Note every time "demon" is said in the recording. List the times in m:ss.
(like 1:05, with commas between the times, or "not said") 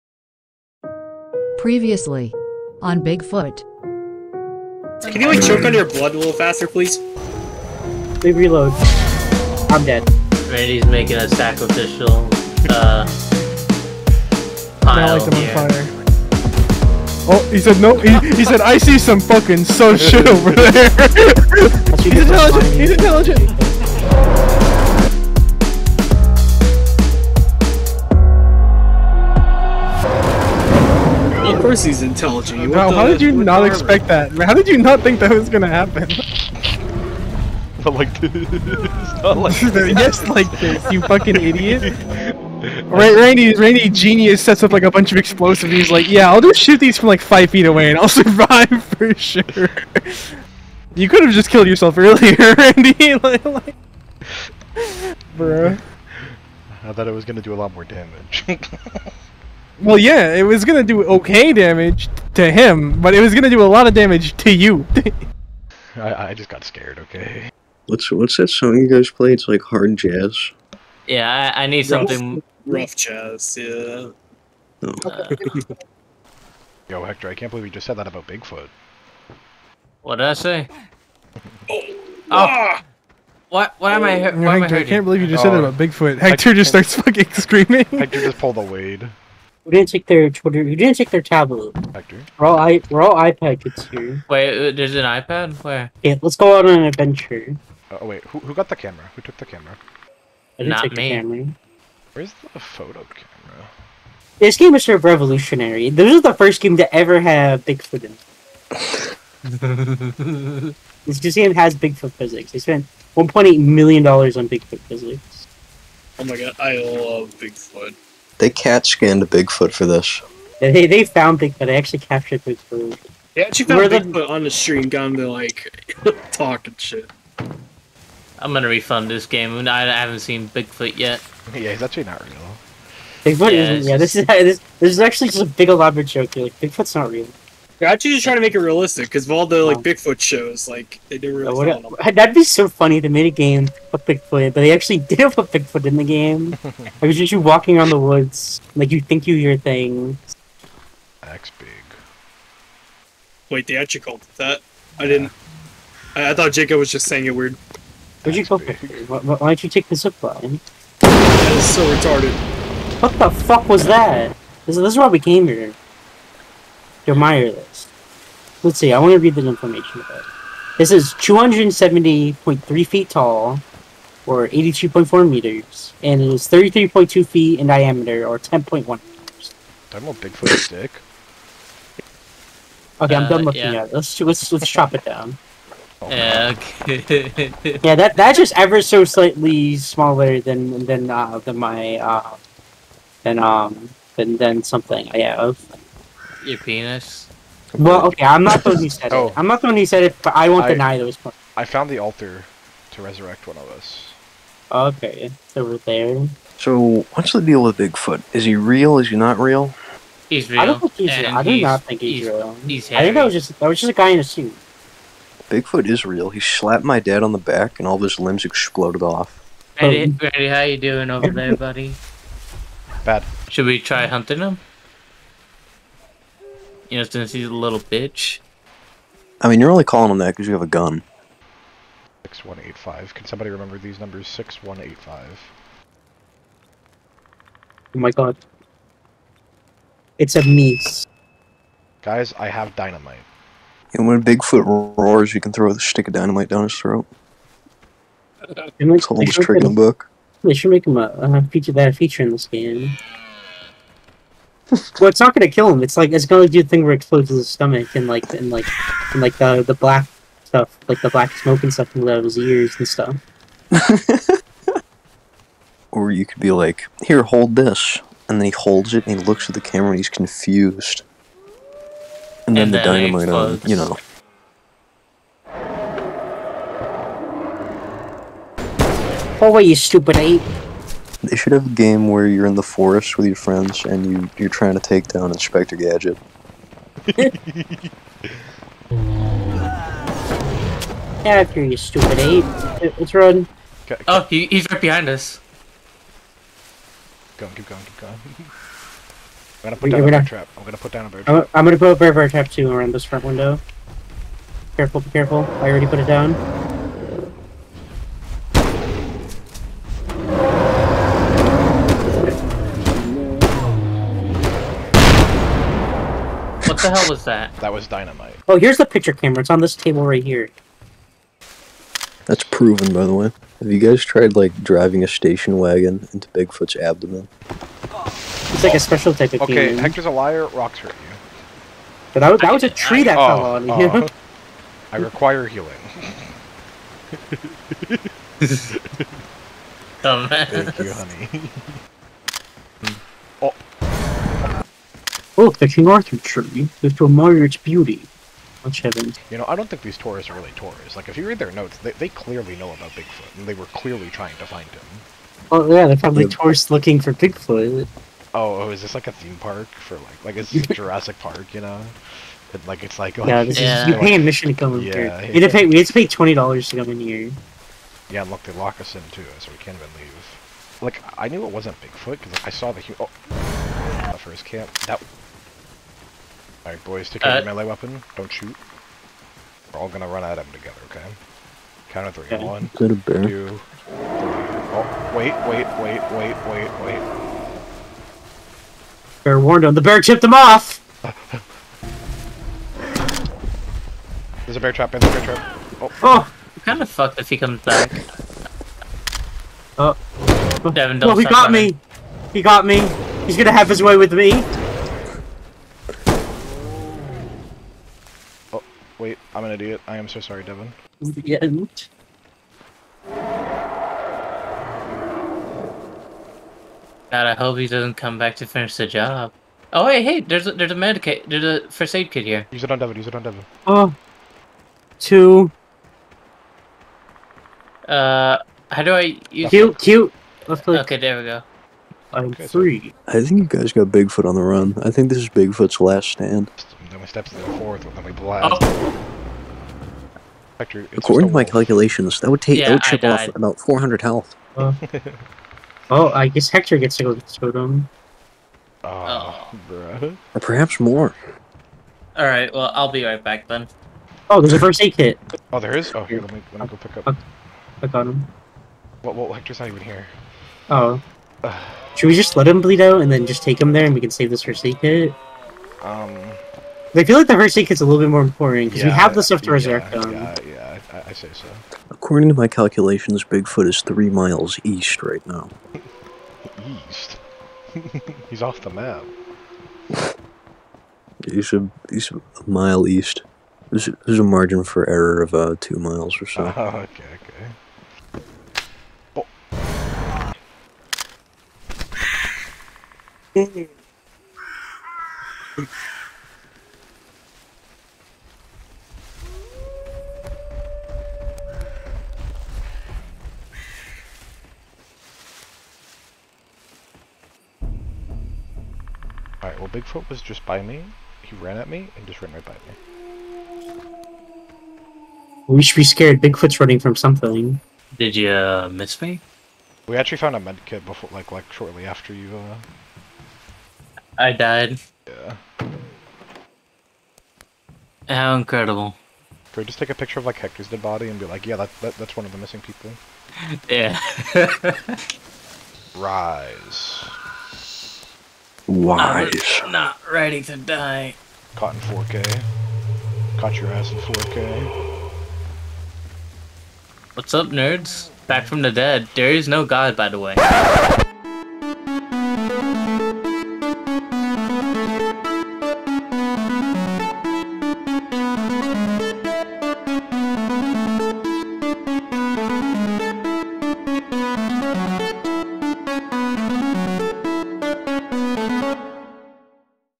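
5:29.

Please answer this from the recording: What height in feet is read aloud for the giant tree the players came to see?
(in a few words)
270.3 feet.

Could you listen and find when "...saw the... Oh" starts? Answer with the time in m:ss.
6:12.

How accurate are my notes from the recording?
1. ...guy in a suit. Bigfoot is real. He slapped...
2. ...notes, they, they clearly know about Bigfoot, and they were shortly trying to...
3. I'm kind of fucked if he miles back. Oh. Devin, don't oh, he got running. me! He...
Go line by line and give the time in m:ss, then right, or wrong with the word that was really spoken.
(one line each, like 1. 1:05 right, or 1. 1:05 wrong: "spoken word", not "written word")
1. 3:33 right
2. 5:51 wrong: "clearly", not "shortly"
3. 6:36 wrong: "comes", not "miles".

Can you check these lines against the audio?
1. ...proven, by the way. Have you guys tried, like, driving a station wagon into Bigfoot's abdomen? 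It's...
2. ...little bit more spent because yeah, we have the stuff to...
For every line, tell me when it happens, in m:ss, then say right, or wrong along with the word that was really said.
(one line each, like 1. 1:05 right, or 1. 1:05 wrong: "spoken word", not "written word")
1. 5:22 right
2. 7:47 wrong: "important", not "spent".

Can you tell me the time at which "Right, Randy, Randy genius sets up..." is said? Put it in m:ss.
0:42.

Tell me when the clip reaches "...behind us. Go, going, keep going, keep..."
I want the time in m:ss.
4:54.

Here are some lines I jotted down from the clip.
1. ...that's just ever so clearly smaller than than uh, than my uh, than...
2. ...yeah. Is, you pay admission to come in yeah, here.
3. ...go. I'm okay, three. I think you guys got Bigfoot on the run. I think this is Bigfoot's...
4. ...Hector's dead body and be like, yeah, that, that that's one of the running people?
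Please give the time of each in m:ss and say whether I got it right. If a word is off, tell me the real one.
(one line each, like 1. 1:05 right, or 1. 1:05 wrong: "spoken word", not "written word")
1. 3:08 wrong: "slightly", not "clearly"
2. 6:03 right
3. 7:11 right
4. 8:50 wrong: "missing", not "running".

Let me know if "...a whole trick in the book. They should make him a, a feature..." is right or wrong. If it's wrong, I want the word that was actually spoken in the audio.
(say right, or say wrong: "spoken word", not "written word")
right.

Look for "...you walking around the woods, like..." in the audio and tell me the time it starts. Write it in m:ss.
2:27.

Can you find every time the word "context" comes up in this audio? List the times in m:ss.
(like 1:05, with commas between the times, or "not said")
not said.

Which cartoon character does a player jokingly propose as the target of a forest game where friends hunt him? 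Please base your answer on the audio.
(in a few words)
Inspector Gadget.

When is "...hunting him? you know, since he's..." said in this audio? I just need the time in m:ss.
3:44.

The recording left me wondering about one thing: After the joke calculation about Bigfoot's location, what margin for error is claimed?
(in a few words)
2 miles.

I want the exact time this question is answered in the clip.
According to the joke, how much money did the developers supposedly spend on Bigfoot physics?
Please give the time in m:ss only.
1:53.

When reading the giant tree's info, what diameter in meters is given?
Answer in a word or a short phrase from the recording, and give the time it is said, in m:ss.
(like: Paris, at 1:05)
10.1 meters, at 2:58.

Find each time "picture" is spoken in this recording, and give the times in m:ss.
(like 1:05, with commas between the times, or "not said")
5:18, 8:49.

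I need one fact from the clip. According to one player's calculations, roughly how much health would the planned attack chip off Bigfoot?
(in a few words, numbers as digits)
400.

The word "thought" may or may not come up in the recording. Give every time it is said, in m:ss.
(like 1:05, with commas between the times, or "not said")
0:56, 2:36.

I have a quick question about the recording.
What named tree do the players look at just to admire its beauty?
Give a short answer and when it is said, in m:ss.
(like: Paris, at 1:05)
King Arthur tree, at 5:45.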